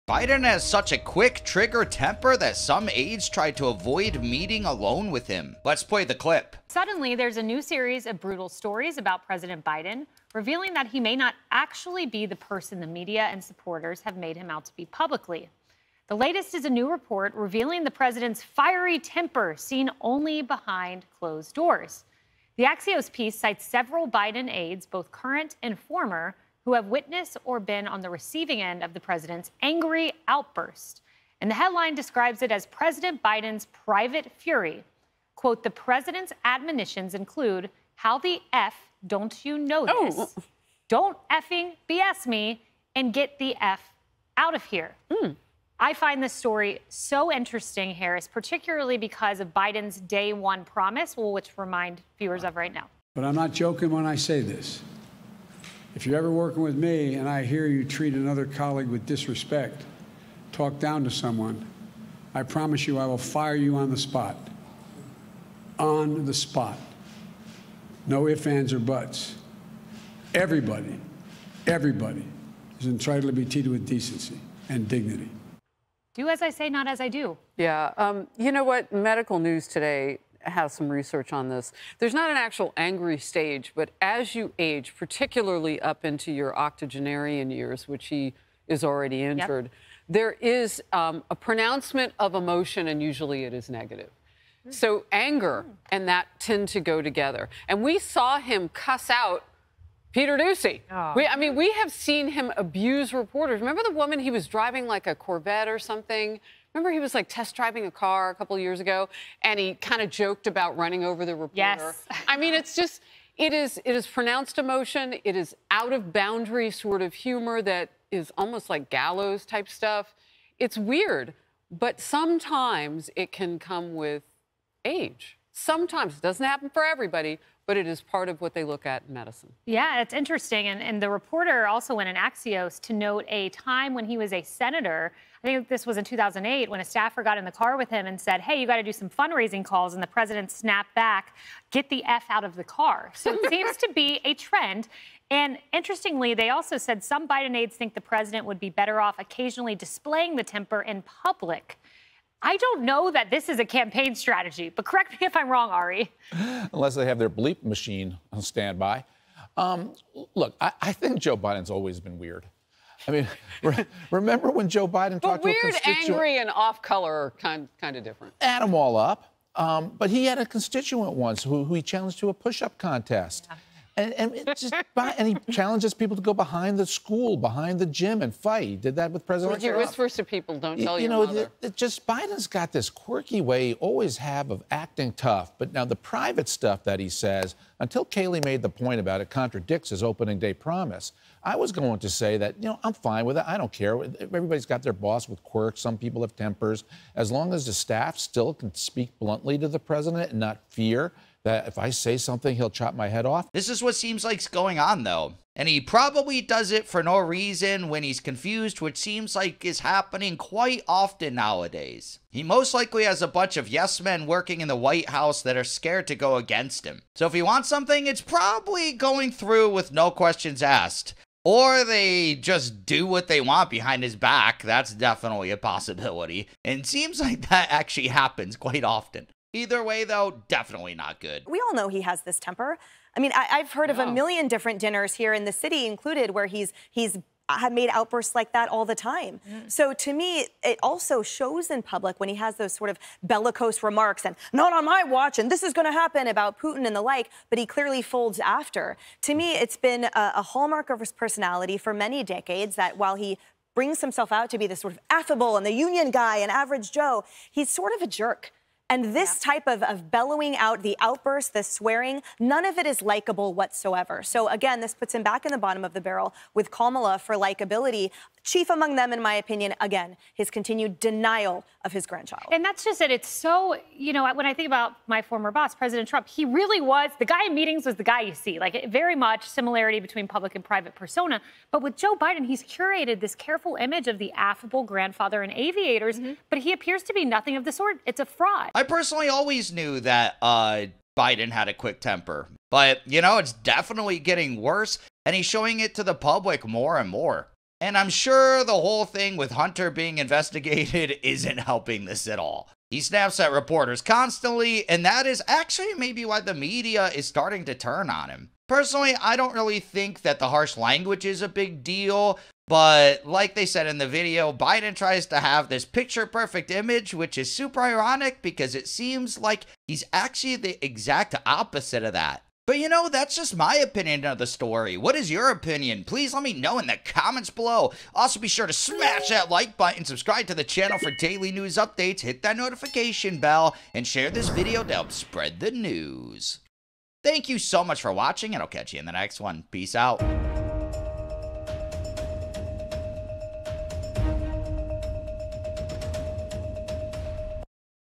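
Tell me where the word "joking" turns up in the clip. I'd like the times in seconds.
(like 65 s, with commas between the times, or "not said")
53 s.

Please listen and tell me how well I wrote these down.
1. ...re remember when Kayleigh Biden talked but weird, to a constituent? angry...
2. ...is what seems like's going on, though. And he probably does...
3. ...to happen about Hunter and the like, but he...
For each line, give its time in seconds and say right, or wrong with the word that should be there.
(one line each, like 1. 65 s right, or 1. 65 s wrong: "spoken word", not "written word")
1. 163 s wrong: "Joe", not "Kayleigh"
2. 203 s right
3. 245 s wrong: "Putin", not "Hunter".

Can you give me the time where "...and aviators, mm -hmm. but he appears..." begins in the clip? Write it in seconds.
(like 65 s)
285 s.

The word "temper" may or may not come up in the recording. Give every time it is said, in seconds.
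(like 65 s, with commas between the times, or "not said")
1 s, 18 s, 150 s, 196 s, 232 s, 292 s.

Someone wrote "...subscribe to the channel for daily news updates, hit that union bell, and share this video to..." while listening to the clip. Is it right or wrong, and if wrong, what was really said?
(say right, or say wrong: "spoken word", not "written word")
wrong: "notification", not "union".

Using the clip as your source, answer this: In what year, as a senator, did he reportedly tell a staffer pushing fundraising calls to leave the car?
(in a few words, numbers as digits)
2008.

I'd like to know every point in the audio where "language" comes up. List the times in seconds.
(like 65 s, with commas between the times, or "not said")
310 s.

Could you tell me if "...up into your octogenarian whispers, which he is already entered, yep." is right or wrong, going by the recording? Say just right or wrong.
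wrong.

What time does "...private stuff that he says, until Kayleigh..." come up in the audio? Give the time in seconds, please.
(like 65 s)
185 s.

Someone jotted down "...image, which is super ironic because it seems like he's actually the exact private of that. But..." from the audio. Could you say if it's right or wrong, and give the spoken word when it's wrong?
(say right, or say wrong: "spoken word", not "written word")
wrong: "opposite", not "private".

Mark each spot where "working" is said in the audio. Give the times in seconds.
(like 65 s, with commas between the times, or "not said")
56 s, 214 s.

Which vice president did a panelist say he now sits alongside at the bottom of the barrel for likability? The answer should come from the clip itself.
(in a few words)
Kamala.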